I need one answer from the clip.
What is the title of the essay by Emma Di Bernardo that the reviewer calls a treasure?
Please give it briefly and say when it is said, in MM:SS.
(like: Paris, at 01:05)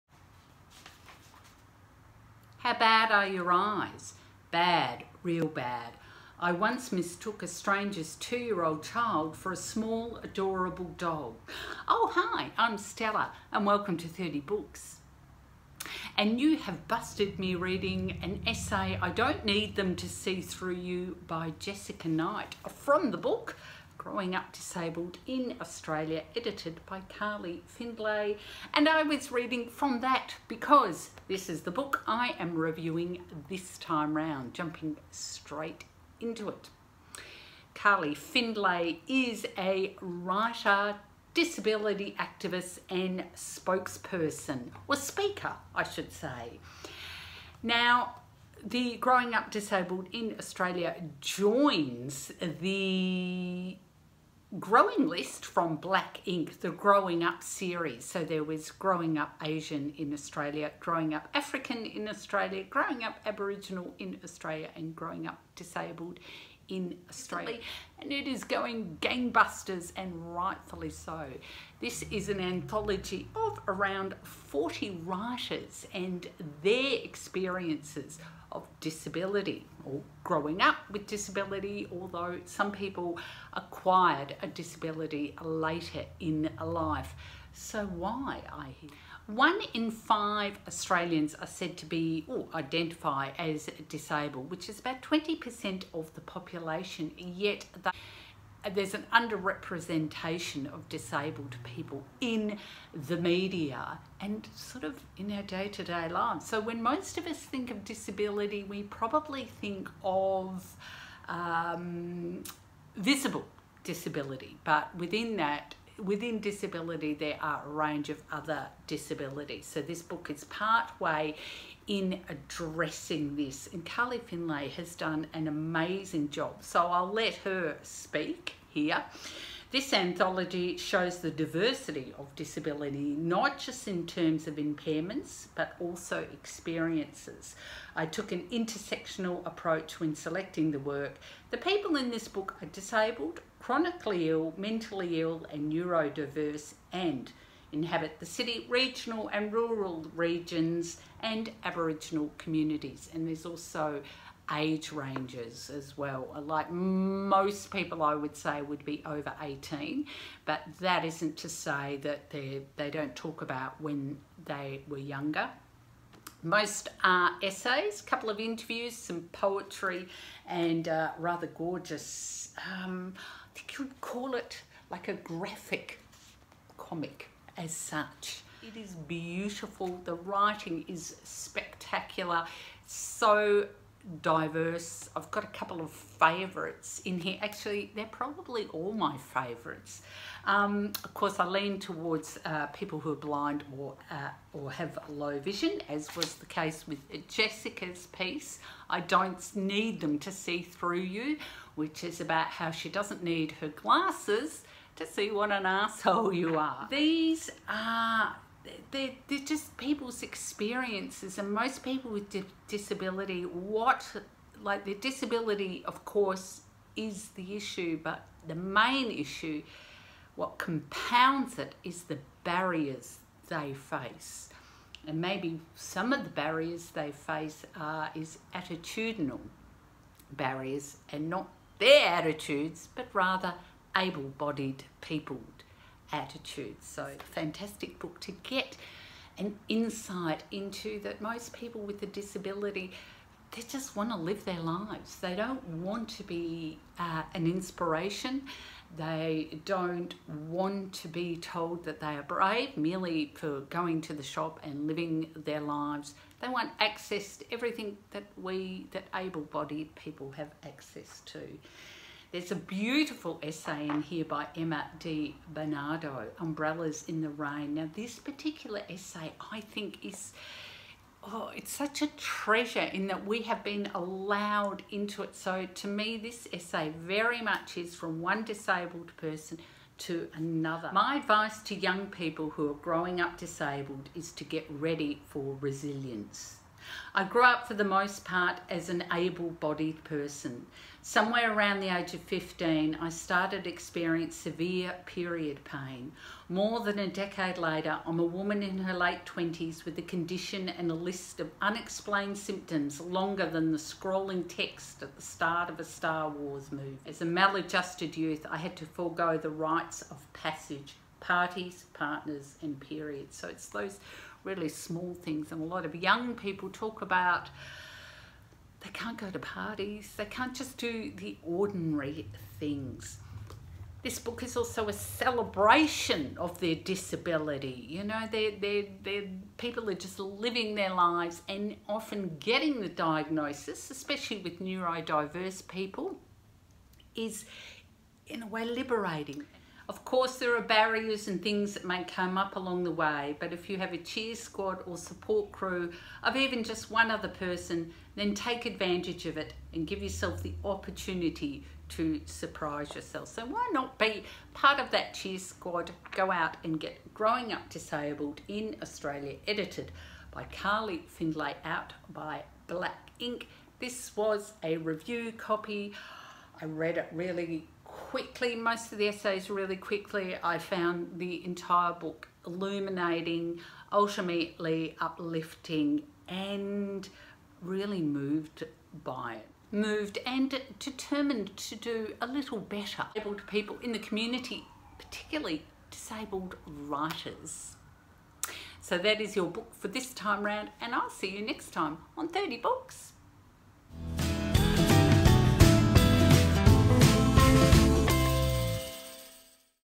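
Umbrellas in the Rain, at 04:26.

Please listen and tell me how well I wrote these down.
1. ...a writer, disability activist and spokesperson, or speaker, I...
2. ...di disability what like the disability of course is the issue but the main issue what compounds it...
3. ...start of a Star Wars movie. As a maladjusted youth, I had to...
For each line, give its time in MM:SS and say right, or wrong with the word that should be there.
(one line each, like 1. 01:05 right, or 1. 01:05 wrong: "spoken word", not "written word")
1. 00:39 right
2. 03:32 right
3. 05:05 right.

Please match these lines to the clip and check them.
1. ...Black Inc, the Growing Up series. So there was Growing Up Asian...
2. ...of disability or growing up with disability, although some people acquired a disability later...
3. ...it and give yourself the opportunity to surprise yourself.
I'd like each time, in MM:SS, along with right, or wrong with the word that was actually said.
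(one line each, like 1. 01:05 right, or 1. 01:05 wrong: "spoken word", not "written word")
1. 00:55 right
2. 01:18 right
3. 05:49 right.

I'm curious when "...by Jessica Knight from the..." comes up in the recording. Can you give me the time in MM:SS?
00:21.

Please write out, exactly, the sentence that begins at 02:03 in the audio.
And Carly Findlay has done an amazing job.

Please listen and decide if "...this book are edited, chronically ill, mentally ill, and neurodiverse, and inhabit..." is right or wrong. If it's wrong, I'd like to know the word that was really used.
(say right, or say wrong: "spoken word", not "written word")
wrong: "disabled", not "edited".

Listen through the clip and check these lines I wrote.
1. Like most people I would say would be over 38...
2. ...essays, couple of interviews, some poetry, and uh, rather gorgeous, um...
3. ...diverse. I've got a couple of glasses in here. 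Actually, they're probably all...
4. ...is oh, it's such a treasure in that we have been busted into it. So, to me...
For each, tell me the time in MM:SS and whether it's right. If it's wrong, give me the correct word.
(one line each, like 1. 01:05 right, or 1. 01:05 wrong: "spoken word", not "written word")
1. 02:36 wrong: "18", not "38"
2. 02:47 right
3. 03:04 wrong: "favourites", not "glasses"
4. 04:30 wrong: "allowed", not "busted".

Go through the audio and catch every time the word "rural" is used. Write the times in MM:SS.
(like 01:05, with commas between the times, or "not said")
02:29.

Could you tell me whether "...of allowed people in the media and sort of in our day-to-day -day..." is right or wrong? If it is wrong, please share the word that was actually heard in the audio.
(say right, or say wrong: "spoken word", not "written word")
wrong: "disabled", not "allowed".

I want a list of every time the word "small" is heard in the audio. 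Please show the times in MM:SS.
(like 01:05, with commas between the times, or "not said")
00:09, 05:14.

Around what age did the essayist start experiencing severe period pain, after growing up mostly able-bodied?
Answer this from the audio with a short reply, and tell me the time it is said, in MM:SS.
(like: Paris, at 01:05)
15, at 04:51.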